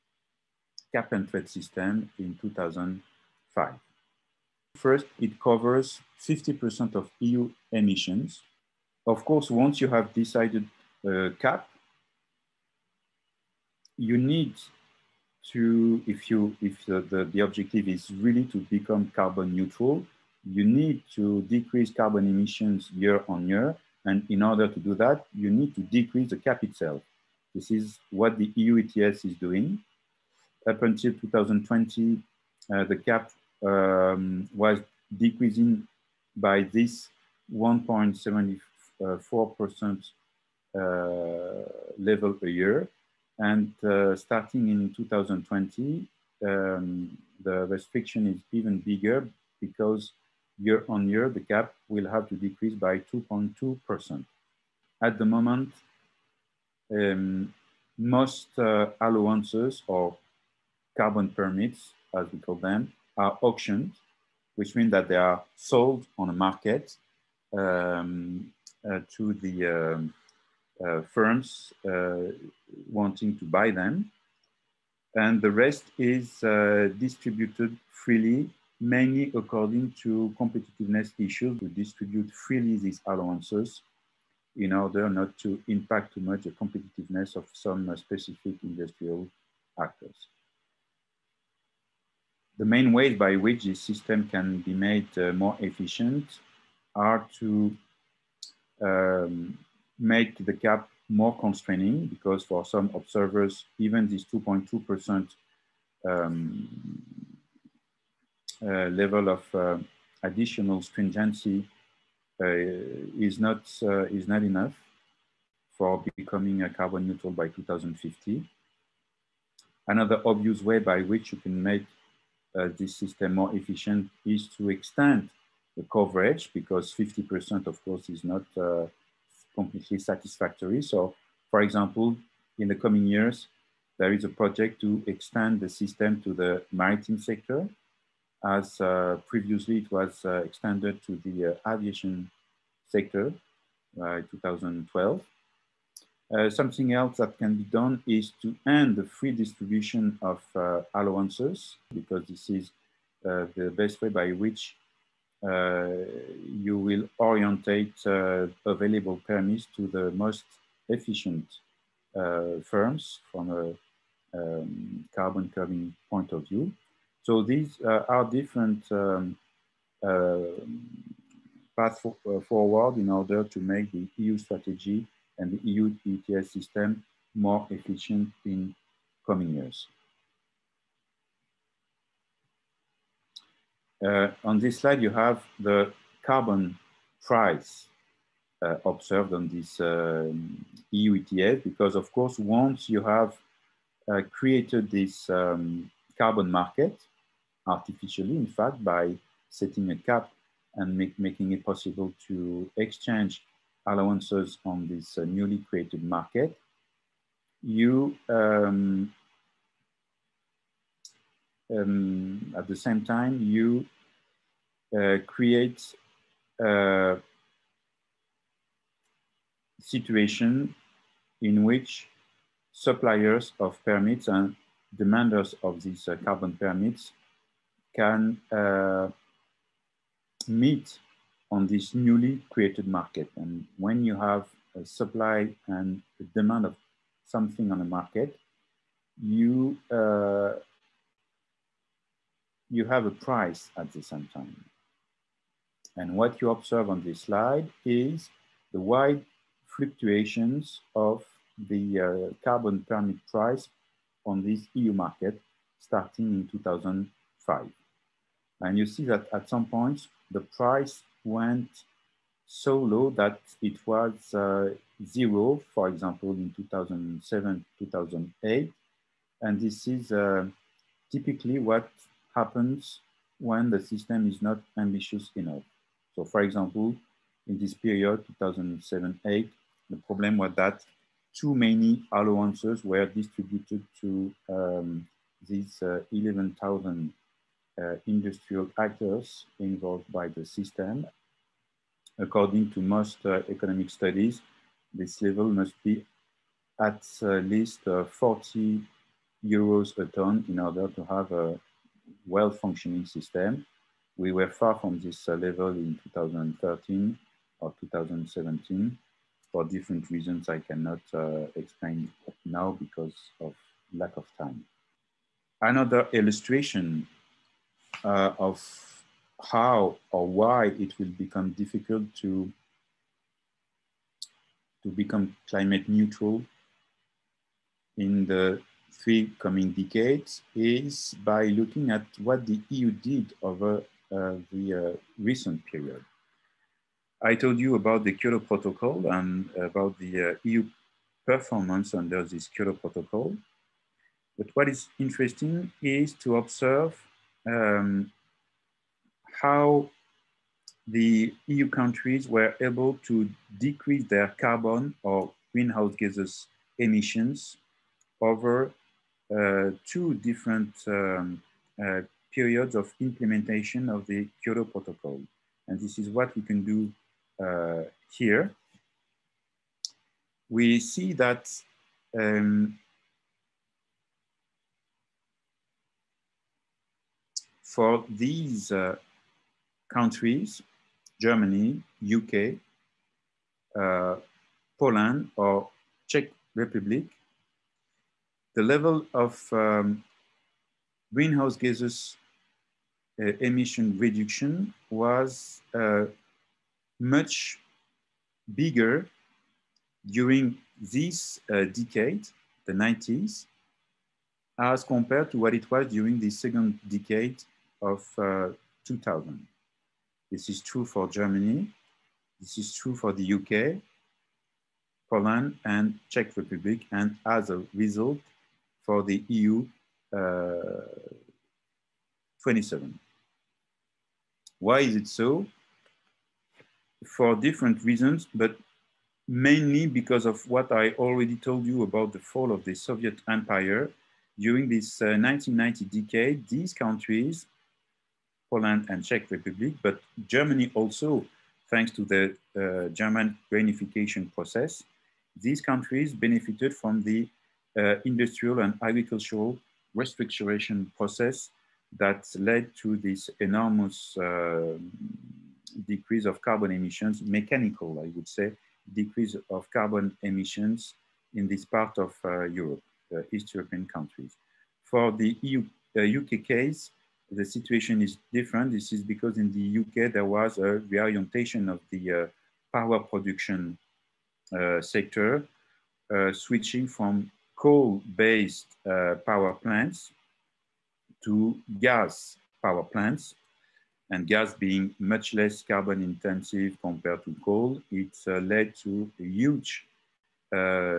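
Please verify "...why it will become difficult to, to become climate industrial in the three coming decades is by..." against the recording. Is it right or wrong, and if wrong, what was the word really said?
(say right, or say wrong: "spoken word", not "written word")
wrong: "neutral", not "industrial".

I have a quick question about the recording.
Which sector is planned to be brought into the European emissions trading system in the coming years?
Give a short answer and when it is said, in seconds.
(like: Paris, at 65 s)
maritime sector, at 136 s.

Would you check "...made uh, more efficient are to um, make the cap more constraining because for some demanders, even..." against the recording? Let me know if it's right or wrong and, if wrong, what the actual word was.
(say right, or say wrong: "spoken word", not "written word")
wrong: "observers", not "demanders".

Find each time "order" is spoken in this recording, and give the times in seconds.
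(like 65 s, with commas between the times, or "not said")
24 s, 84 s, 173 s, 300 s.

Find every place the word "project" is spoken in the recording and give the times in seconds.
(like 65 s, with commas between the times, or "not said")
134 s.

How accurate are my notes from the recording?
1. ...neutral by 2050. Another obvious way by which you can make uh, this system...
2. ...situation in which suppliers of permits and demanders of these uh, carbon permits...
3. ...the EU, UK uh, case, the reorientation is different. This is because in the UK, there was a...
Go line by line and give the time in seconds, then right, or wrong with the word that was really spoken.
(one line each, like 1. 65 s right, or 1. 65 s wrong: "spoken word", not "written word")
1. 117 s right
2. 219 s right
3. 465 s wrong: "situation", not "reorientation".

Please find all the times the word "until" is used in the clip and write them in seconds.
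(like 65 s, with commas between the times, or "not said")
30 s.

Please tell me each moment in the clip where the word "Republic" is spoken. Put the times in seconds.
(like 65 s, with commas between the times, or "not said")
386 s, 416 s, 439 s.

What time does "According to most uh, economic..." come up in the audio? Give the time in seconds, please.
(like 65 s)
292 s.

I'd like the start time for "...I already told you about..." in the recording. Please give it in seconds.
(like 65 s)
430 s.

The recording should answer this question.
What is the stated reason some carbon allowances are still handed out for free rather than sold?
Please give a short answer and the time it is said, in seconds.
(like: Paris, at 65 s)
competitiveness issues, at 80 s.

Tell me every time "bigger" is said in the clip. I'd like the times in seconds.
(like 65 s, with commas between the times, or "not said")
48 s, 398 s.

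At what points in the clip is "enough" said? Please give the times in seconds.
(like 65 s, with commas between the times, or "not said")
114 s, 275 s.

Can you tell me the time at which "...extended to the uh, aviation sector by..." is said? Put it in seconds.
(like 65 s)
140 s.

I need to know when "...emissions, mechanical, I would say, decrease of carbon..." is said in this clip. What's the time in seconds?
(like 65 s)
456 s.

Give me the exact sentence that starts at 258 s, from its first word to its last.
And you see that at some points, the price went so low that it was uh, zero, for example, in 2007, 2008.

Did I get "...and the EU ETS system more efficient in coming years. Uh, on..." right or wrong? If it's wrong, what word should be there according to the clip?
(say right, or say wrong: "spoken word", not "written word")
right.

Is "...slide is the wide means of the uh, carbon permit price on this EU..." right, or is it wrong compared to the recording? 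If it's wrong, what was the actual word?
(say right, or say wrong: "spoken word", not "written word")
wrong: "fluctuations", not "means".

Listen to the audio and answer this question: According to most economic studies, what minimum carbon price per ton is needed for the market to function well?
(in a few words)
40 euros.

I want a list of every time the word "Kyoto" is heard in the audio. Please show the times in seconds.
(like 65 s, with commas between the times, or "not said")
338 s, 342 s, 364 s.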